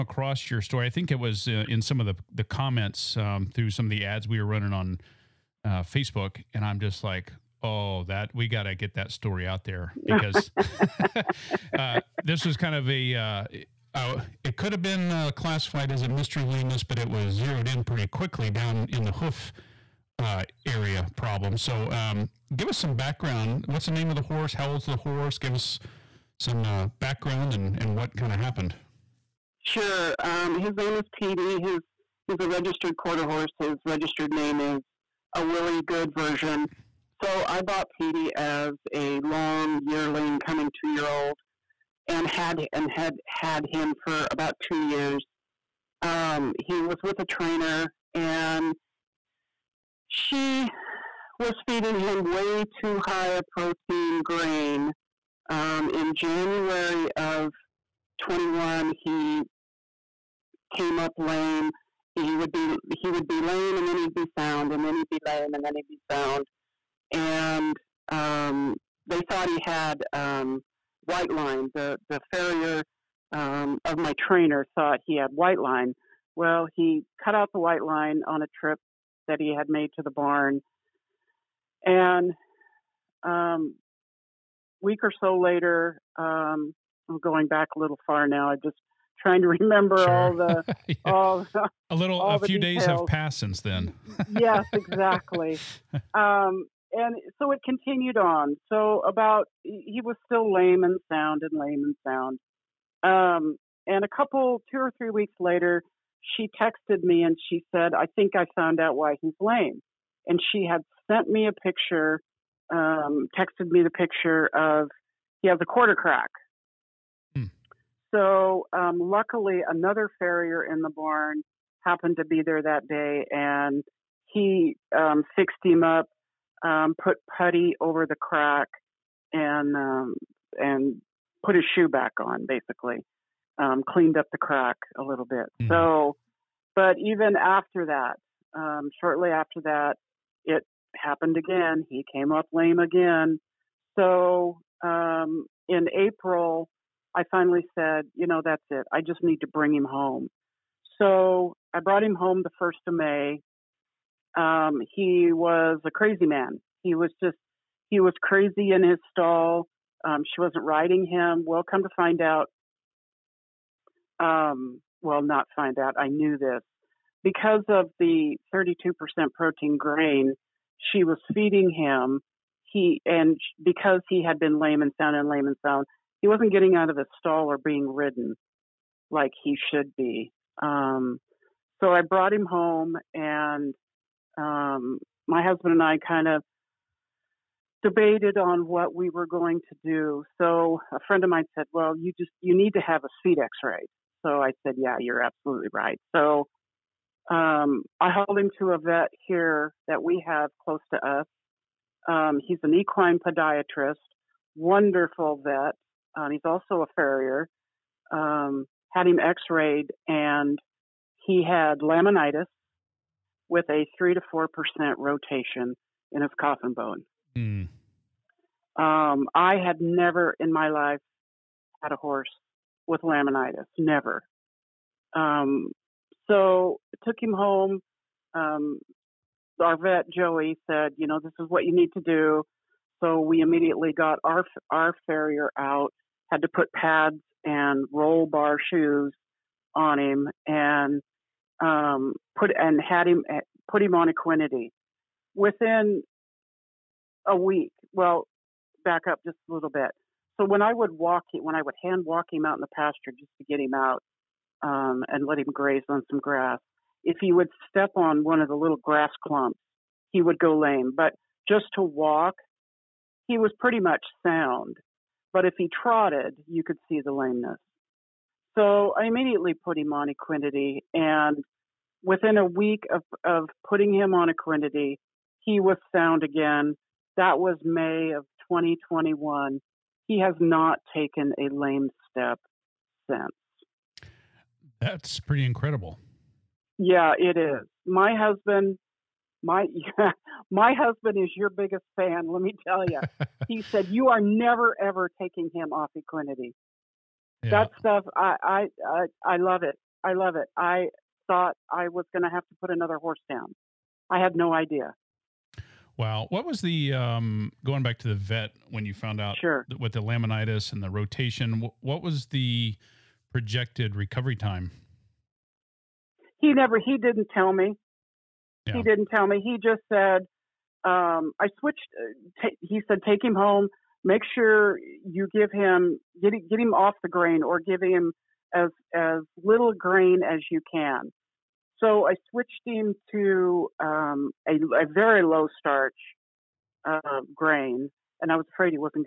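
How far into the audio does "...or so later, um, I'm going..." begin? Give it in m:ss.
1:25.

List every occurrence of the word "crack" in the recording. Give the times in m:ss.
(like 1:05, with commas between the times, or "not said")
1:55, 2:08, 2:14.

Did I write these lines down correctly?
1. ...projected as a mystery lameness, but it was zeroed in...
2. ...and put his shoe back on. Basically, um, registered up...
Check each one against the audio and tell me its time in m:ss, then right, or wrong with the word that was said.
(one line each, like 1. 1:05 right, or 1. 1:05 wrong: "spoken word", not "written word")
1. 0:15 wrong: "classified", not "projected"
2. 2:10 wrong: "cleaned", not "registered".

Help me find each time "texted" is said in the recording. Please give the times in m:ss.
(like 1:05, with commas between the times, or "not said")
1:46, 1:53.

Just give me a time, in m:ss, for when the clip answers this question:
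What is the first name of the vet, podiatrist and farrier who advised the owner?
3:50.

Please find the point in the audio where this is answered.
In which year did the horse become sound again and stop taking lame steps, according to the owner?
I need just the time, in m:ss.
4:38.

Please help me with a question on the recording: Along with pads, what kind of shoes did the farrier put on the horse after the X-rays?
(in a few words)
roll bar shoes.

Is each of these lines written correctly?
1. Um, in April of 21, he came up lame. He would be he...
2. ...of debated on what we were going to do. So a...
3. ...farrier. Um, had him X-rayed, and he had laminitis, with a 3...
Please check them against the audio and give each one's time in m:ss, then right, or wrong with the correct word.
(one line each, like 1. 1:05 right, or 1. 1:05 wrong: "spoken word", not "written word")
1. 0:55 wrong: "January", not "April"
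2. 3:06 right
3. 3:26 right.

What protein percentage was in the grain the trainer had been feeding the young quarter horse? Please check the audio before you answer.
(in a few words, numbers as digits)
32%.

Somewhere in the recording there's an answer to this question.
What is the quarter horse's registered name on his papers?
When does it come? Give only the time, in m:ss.
0:35.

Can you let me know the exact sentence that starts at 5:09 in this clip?
with the laminitis and the rotation, what was the projected recovery time?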